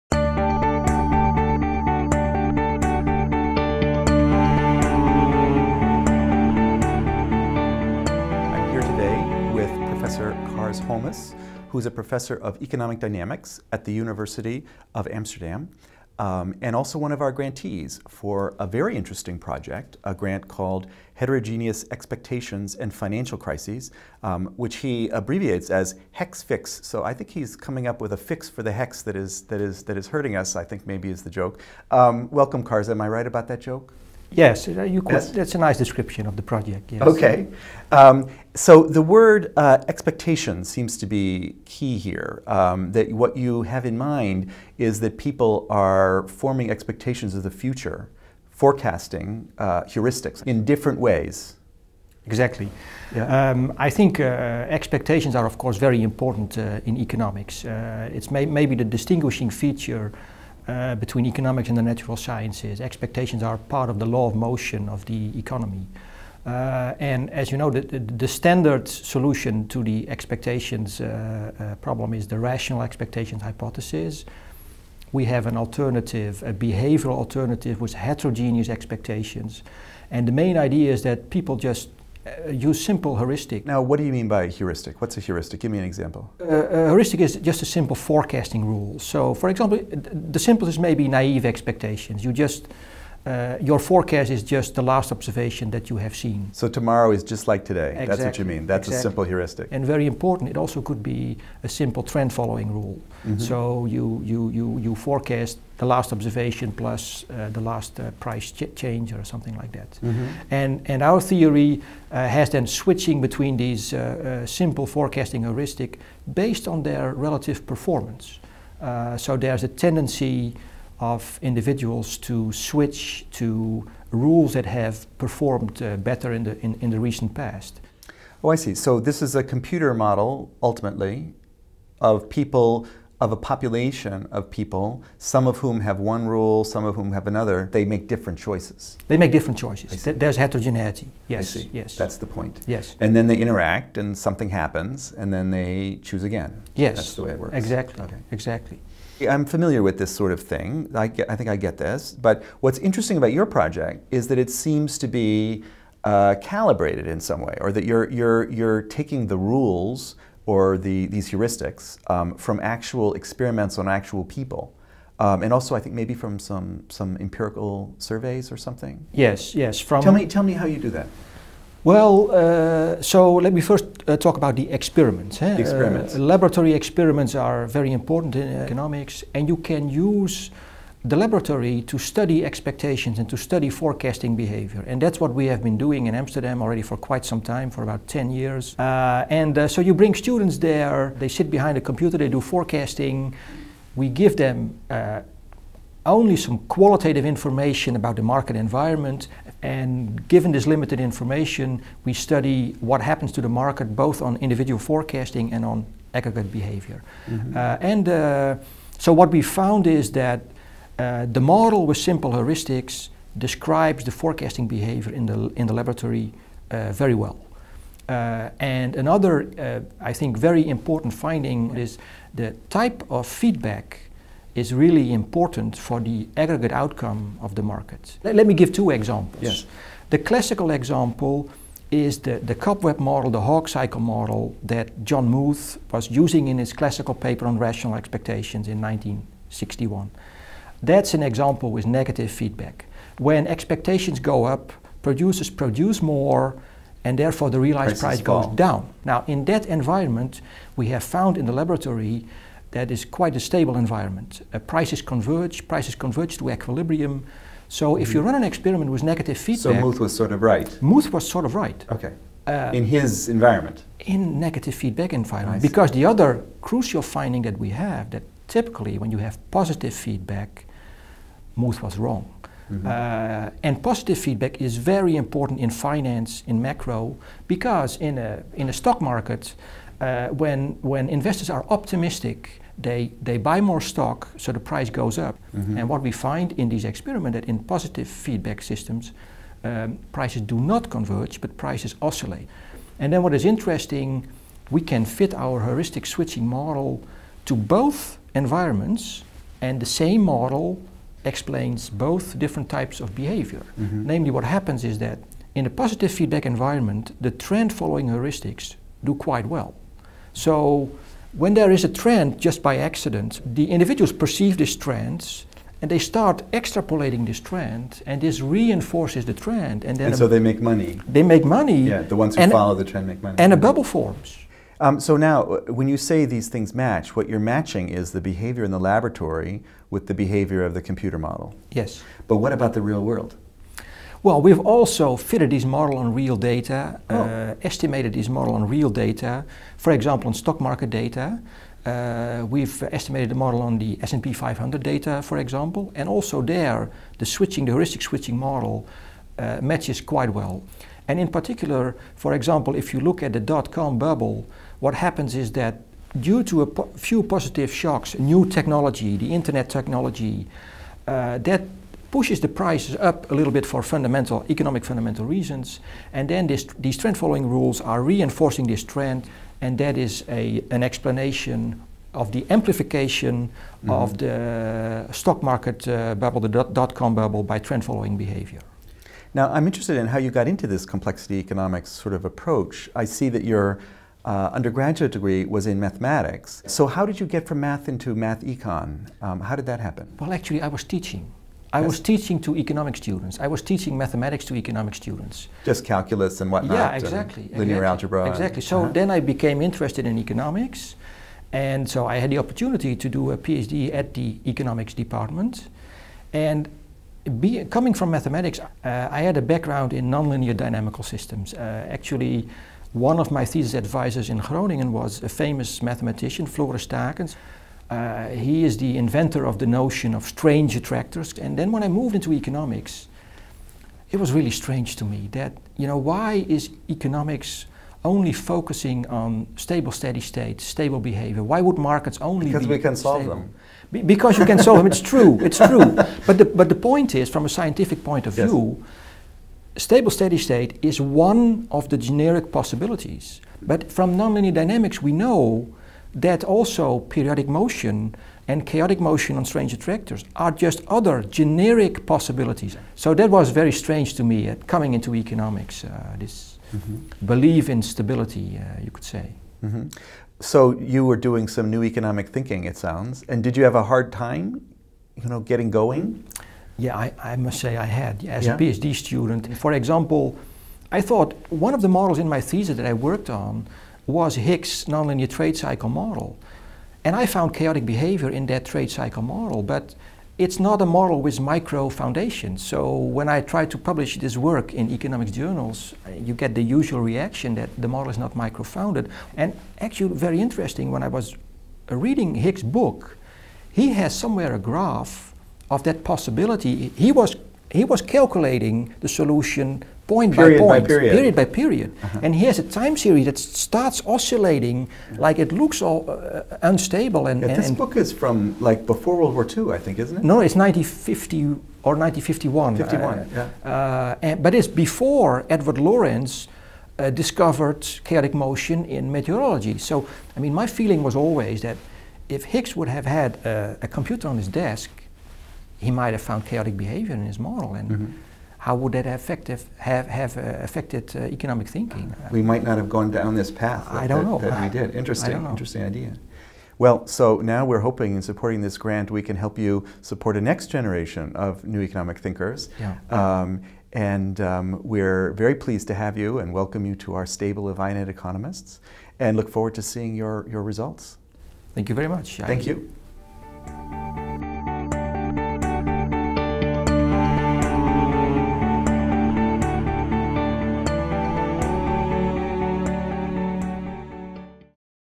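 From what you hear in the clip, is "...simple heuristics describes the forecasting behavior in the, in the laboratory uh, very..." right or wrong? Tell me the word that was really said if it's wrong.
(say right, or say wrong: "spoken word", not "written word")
right.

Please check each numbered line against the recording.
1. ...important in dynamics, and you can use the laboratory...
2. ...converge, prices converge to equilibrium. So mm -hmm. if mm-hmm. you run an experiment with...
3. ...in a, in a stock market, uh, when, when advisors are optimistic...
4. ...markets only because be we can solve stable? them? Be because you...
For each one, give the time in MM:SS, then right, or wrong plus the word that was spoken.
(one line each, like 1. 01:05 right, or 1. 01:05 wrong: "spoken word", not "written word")
1. 02:57 wrong: "economics", not "dynamics"
2. 04:15 right
3. 04:37 wrong: "investors", not "advisors"
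4. 07:11 right.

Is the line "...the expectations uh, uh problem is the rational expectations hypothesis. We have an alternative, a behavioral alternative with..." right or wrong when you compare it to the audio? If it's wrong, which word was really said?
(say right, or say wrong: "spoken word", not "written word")
right.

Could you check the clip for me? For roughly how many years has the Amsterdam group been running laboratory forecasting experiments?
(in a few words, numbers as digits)
10 years.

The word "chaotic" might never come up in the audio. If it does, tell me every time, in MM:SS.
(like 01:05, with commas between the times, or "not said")
07:28, 07:57, 08:38, 08:46.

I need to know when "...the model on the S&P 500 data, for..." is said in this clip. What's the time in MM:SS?
05:43.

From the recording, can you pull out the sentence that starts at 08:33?
Uh, and, but it's before Edward Lorenz.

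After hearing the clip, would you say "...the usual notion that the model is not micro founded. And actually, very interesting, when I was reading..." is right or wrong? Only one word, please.
wrong.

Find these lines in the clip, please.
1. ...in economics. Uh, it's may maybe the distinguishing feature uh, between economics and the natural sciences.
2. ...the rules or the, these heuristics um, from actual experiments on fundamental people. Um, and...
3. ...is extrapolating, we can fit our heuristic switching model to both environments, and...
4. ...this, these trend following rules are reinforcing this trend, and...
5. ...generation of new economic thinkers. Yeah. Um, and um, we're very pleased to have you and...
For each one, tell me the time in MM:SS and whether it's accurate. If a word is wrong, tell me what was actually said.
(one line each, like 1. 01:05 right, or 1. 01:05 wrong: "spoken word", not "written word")
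1. 00:56 right
2. 02:39 wrong: "actual", not "fundamental"
3. 04:53 wrong: "interesting", not "extrapolating"
4. 06:06 right
5. 09:00 right.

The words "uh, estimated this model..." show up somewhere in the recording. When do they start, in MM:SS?
05:37.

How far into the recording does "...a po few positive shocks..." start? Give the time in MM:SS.
05:56.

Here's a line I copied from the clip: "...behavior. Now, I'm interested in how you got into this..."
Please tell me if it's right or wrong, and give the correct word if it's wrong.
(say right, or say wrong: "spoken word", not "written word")
right.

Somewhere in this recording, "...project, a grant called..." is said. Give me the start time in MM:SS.
00:19.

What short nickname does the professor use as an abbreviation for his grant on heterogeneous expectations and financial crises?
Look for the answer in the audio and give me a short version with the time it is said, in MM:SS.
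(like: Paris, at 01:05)
hex fix, at 00:26.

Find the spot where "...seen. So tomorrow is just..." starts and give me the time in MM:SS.
01:36.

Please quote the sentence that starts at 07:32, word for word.
So that was very strange to me uh, coming into economics, uh, this mm -hmm.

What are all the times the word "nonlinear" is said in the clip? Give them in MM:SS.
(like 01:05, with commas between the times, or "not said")
06:50, 07:24, 07:54.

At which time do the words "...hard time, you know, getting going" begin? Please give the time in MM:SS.
07:43.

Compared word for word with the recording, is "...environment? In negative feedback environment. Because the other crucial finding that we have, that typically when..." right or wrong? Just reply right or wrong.
right.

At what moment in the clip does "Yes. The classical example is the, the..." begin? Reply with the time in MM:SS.
03:49.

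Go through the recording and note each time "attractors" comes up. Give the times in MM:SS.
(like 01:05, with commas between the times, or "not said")
07:00, 07:29.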